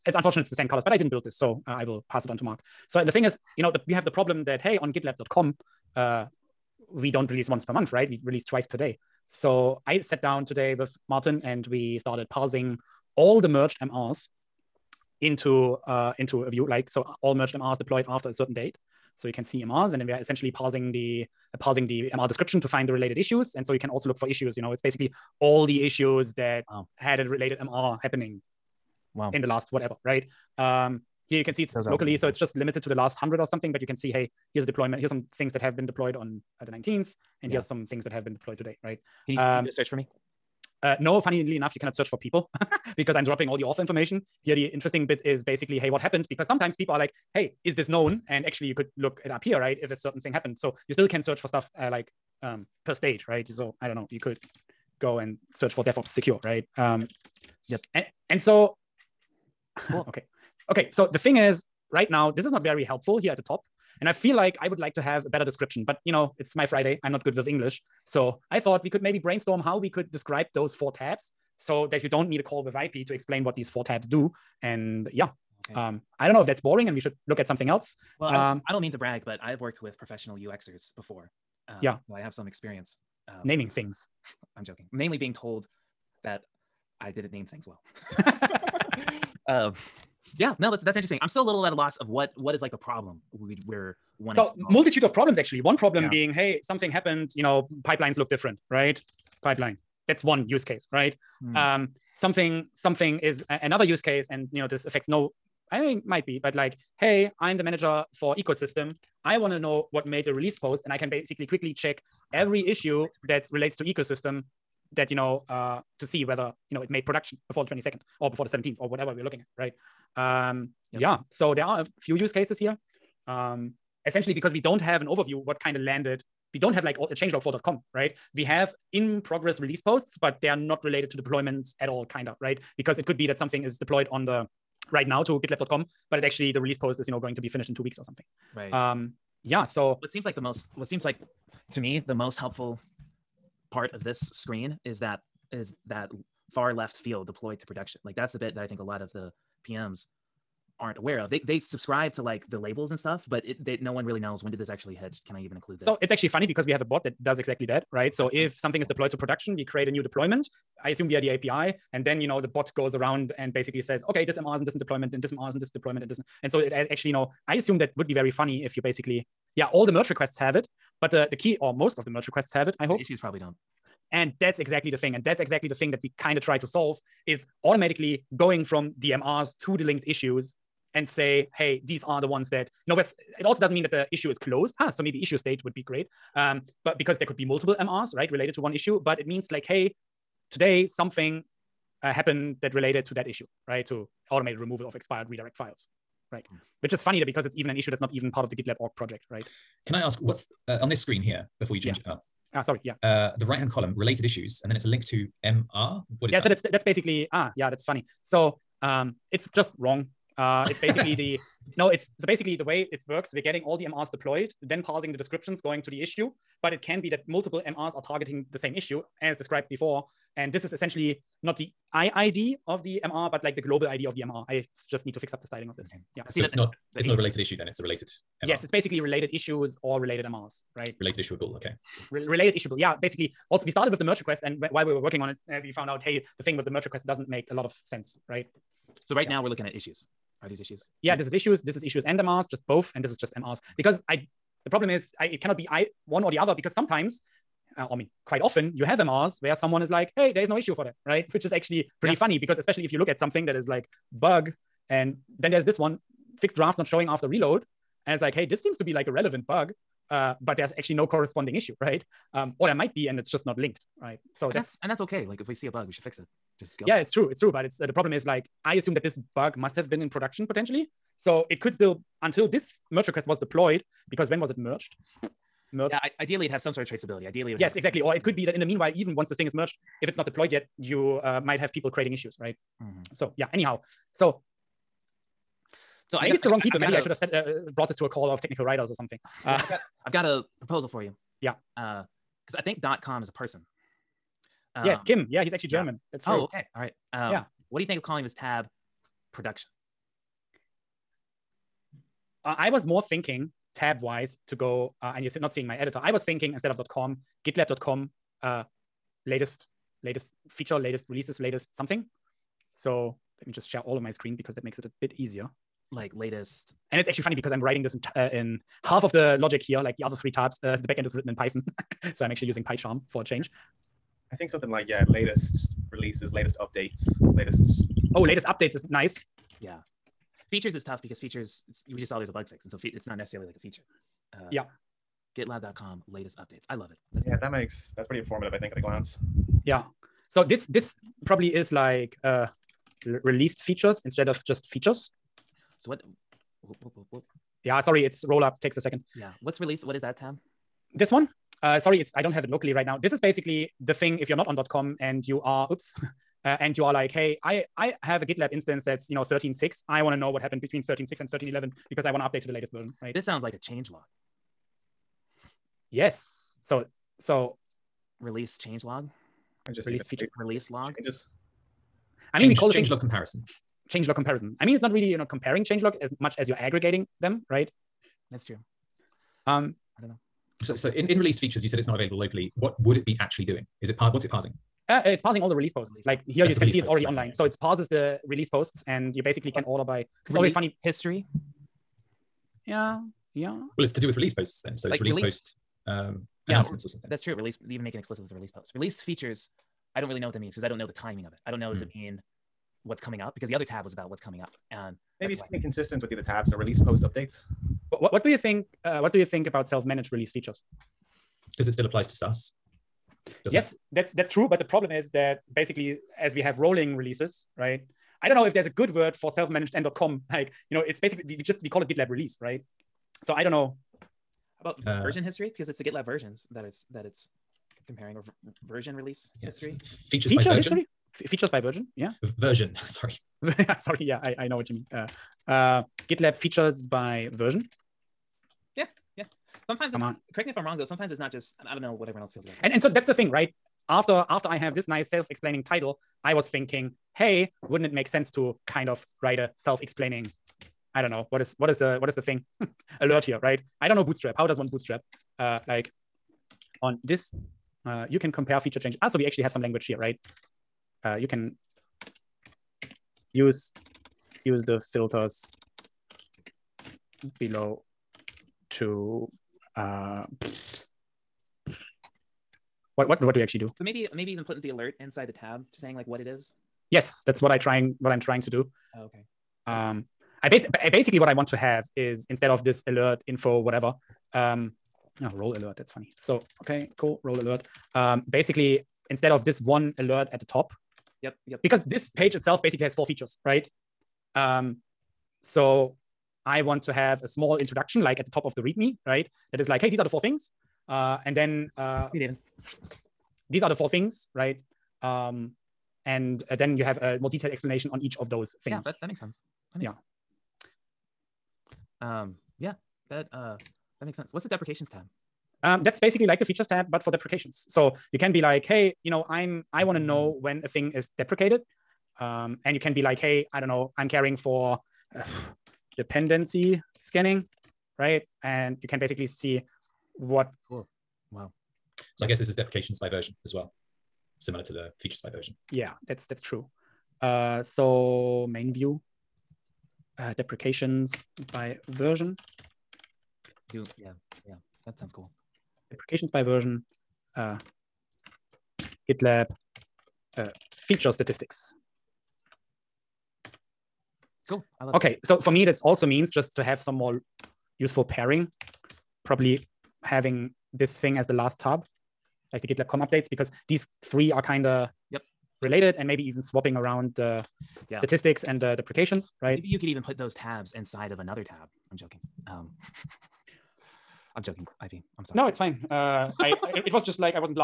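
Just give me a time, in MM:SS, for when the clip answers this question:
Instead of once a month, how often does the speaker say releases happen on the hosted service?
00:08.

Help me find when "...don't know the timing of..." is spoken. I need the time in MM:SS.
06:40.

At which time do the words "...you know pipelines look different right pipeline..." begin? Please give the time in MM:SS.
01:37.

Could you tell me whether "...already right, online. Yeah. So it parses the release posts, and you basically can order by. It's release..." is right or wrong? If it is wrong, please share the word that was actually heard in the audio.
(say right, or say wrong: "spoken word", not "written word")
right.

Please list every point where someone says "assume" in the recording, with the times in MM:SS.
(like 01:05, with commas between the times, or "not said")
02:40, 02:47, 04:28.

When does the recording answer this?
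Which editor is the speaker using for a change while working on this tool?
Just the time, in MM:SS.
05:22.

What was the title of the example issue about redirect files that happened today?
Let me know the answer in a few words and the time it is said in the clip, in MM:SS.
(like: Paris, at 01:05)
automated removal of expired redirect files, at 03:14.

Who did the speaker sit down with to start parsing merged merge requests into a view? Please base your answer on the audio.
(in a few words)
Martin.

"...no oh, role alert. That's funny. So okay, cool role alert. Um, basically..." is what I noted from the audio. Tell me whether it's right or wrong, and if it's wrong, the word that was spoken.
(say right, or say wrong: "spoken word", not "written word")
right.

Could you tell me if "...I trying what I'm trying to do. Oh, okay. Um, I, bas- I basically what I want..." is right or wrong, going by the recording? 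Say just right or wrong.
right.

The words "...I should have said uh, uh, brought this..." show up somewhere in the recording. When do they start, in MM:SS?
04:46.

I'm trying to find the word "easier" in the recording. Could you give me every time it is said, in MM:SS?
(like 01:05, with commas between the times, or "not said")
05:15.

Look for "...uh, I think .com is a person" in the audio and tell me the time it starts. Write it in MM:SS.
04:52.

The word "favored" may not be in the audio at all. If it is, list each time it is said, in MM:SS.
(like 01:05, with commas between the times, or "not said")
not said.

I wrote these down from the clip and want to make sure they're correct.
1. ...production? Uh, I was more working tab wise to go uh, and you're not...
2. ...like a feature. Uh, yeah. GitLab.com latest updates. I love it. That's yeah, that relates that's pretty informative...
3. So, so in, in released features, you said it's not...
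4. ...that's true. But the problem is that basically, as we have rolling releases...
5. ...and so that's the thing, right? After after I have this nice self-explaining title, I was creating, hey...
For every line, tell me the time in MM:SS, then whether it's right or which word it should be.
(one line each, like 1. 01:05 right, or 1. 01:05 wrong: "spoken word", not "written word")
1. 04:59 wrong: "thinking", not "working"
2. 05:33 wrong: "makes", not "relates"
3. 06:20 right
4. 06:54 right
5. 07:22 wrong: "thinking", not "creating".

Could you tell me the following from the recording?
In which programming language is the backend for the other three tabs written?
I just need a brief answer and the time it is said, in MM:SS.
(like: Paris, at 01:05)
Python, at 05:21.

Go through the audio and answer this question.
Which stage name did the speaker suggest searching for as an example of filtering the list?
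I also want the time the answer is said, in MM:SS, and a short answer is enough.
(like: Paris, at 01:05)
DevOps secure, at 00:55.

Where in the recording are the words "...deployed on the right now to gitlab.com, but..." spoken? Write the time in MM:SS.
02:13.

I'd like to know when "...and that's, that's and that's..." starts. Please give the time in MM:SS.
04:24.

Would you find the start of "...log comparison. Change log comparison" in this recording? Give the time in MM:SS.
06:12.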